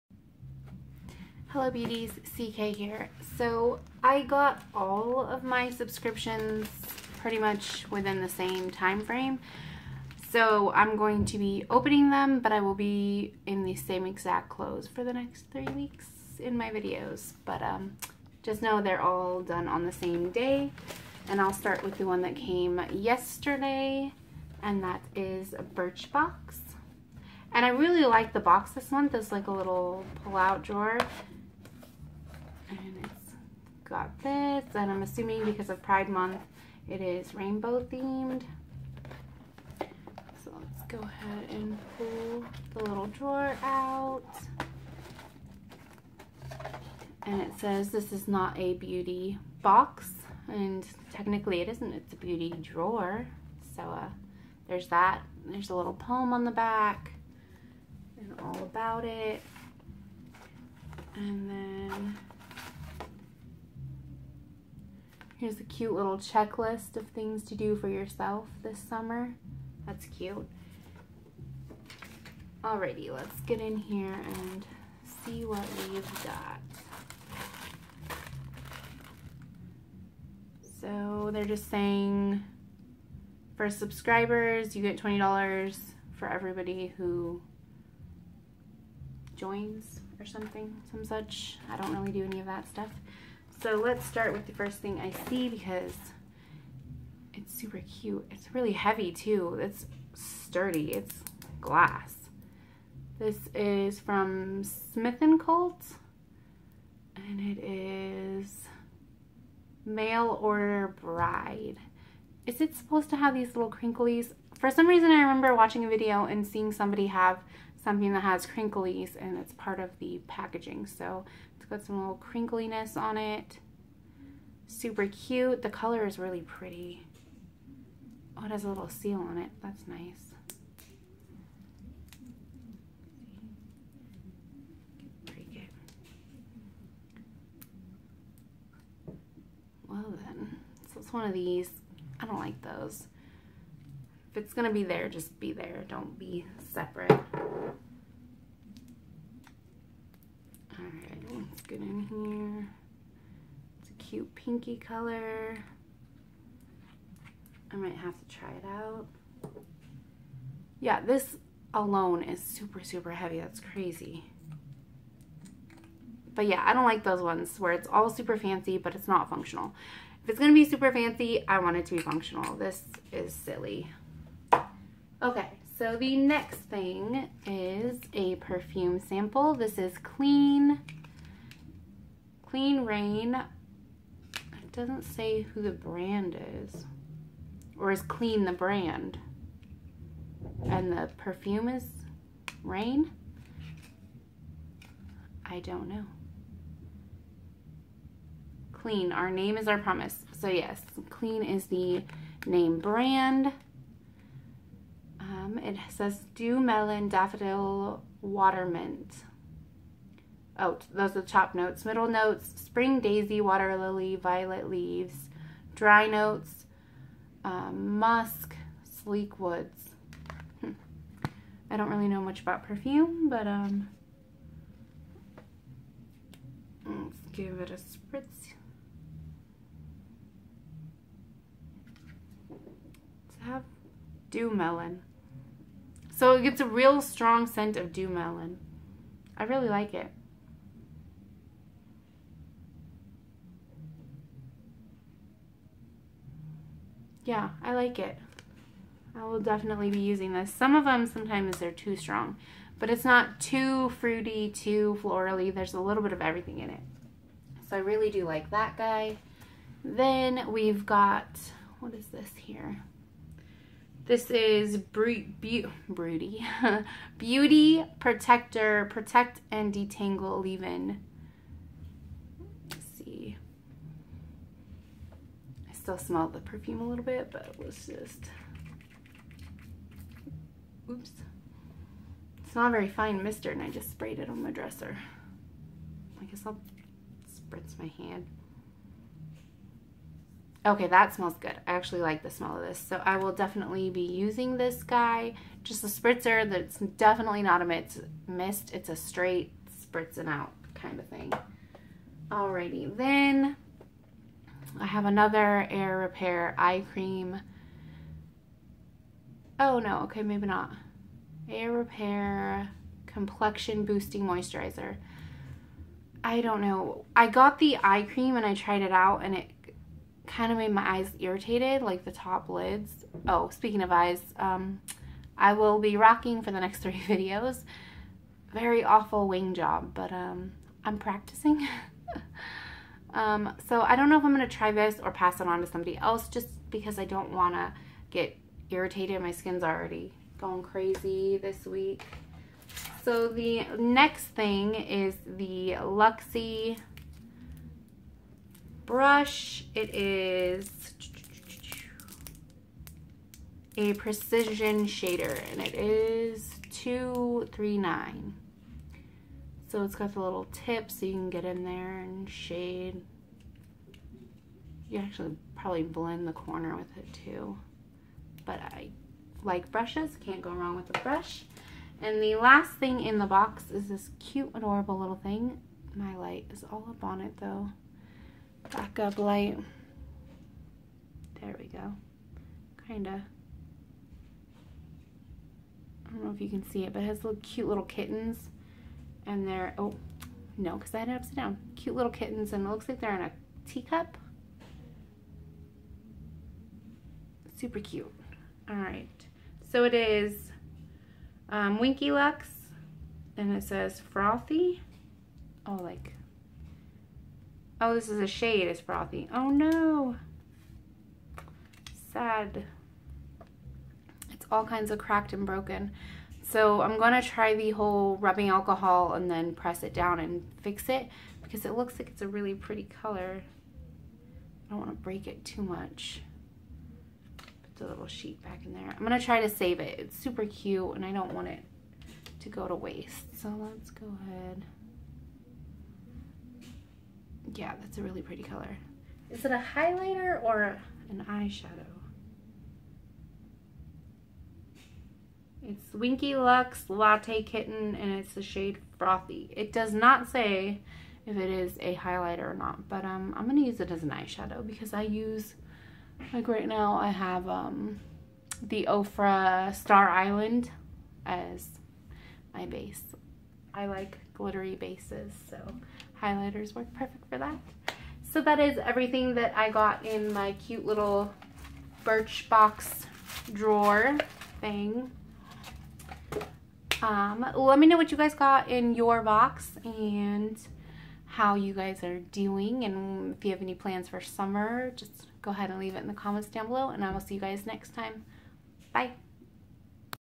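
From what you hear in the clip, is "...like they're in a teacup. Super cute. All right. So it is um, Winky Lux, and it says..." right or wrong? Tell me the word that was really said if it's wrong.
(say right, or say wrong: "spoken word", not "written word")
right.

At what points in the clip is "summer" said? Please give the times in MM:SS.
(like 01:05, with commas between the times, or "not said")
01:08, 08:04.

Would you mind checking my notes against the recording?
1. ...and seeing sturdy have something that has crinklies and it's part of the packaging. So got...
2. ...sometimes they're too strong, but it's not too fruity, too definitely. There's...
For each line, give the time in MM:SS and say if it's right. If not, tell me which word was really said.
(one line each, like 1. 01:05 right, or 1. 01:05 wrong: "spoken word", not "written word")
1. 01:56 wrong: "somebody", not "sturdy"
2. 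04:11 wrong: "florally", not "definitely".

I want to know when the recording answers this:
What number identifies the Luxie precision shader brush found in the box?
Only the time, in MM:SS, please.
05:56.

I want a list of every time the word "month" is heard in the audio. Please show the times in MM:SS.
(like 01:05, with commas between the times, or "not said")
00:28, 00:36.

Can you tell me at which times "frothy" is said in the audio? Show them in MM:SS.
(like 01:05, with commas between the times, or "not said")
06:43, 06:48, 07:28.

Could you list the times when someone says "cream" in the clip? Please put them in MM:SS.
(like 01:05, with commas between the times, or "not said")
05:06, 05:18.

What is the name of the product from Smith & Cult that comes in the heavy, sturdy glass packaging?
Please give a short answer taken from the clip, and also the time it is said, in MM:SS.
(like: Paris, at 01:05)
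Mail Order Bride, at 01:49.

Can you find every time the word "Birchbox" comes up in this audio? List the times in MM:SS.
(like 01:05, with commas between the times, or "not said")
00:25, 07:52.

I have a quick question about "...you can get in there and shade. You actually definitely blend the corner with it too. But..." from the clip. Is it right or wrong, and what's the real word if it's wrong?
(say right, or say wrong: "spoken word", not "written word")
wrong: "probably", not "definitely".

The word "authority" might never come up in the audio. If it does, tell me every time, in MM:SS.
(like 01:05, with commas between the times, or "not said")
not said.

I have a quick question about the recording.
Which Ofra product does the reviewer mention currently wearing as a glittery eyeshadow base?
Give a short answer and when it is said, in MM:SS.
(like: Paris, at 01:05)
Star Island, at 07:39.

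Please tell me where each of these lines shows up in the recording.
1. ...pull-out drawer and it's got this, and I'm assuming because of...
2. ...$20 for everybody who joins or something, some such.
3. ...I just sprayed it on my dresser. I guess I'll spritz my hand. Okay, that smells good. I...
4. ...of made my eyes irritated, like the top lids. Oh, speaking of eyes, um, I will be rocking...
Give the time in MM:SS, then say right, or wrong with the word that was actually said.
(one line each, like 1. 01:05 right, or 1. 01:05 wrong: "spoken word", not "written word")
1. 00:30 right
2. 01:25 right
3. 04:43 right
4. 05:20 right.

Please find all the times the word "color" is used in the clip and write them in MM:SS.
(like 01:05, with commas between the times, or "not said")
02:05, 02:34, 07:03, 07:18.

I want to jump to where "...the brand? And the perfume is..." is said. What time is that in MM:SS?
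03:08.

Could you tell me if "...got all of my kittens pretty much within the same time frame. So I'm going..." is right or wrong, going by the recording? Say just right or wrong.
wrong.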